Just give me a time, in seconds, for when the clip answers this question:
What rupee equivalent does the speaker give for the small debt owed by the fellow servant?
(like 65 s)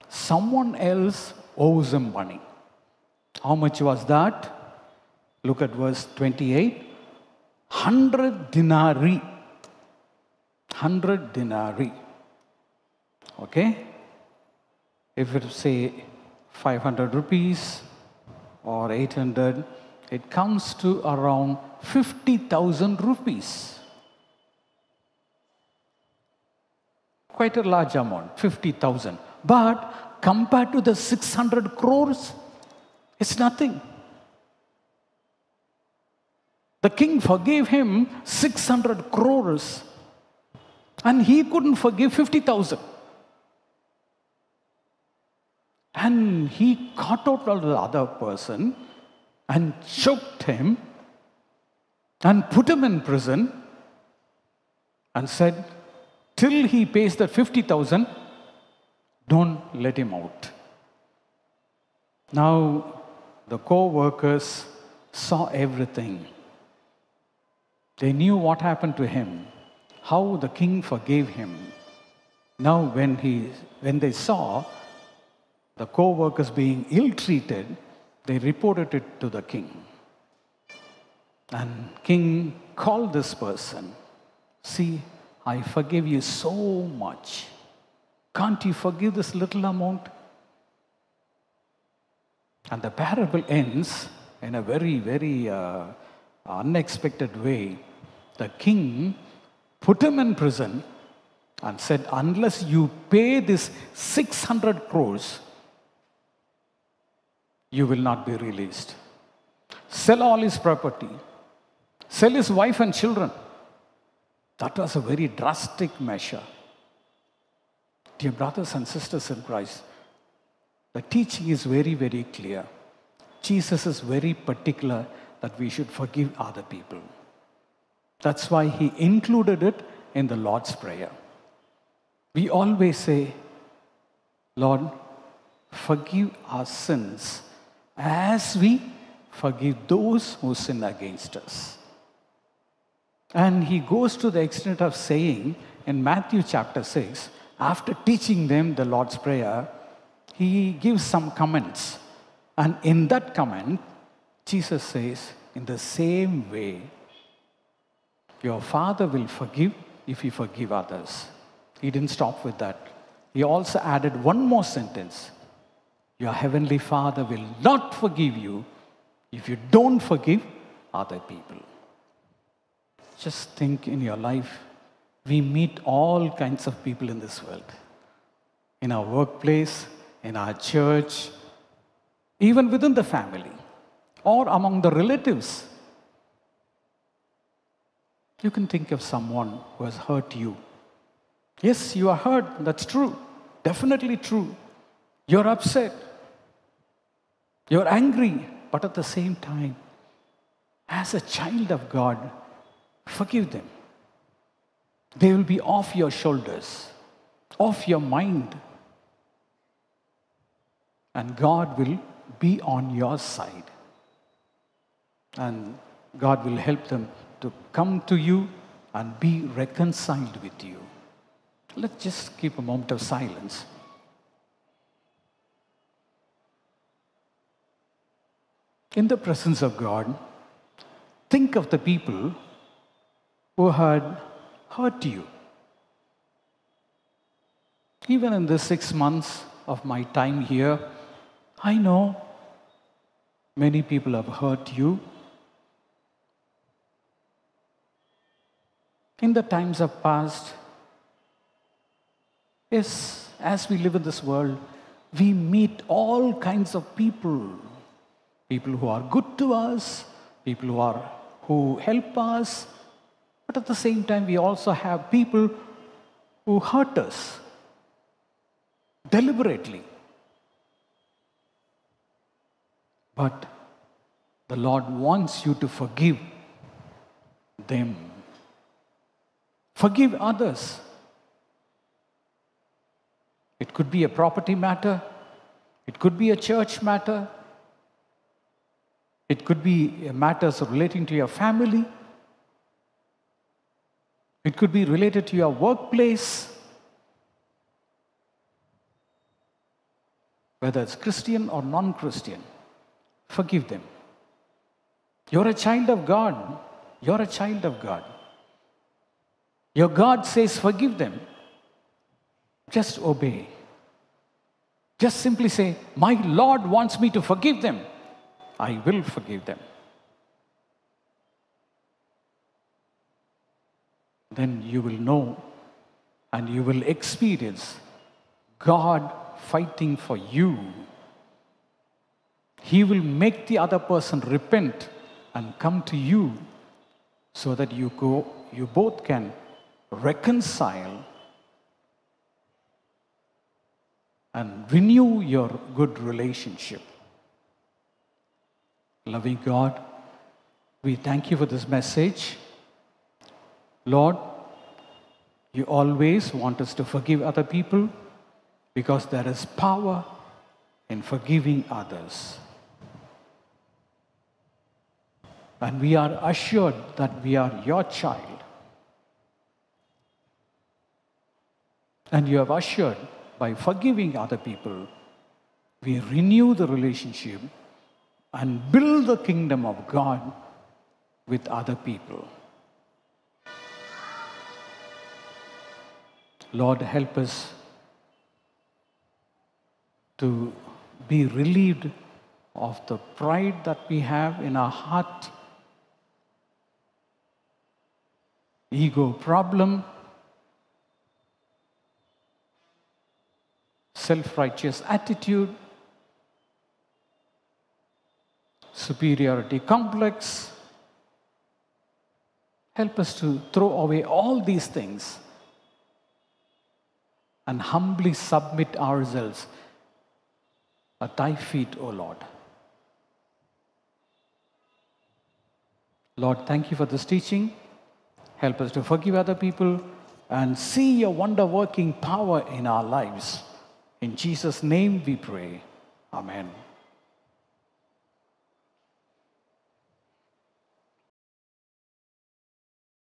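21 s.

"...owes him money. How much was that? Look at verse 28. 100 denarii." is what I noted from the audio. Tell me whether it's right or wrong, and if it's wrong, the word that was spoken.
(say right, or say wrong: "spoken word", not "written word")
right.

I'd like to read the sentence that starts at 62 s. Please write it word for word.
Now, the co workers saw everything.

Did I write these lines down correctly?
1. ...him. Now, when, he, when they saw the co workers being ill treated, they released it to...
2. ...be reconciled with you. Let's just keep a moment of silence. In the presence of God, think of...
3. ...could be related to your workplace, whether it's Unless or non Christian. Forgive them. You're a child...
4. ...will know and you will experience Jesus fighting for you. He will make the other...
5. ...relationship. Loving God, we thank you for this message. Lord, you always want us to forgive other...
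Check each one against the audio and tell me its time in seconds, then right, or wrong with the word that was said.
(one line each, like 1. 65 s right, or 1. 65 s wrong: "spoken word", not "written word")
1. 71 s wrong: "reported", not "released"
2. 219 s right
3. 294 s wrong: "Christian", not "Unless"
4. 324 s wrong: "God", not "Jesus"
5. 345 s right.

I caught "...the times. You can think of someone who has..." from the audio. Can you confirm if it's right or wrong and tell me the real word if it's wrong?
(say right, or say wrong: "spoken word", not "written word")
wrong: "relatives", not "times".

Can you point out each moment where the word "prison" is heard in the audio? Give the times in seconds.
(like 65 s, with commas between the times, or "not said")
53 s, 100 s.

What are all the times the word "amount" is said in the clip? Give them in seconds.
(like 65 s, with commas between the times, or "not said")
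27 s, 89 s.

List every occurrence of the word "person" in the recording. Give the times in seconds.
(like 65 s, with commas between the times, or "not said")
48 s, 83 s, 333 s.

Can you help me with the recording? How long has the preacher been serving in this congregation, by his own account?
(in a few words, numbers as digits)
Six months.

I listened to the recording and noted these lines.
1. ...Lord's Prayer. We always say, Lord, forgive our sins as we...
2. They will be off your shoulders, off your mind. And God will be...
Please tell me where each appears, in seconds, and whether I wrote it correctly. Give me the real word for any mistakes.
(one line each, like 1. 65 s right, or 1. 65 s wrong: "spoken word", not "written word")
1. 130 s right
2. 205 s right.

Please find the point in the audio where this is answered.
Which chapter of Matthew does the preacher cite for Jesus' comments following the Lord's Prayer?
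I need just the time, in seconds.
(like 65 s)
146 s.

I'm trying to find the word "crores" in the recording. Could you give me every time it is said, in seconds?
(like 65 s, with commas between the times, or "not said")
31 s, 39 s, 104 s.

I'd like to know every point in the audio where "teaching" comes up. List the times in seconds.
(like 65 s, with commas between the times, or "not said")
121 s, 147 s, 427 s.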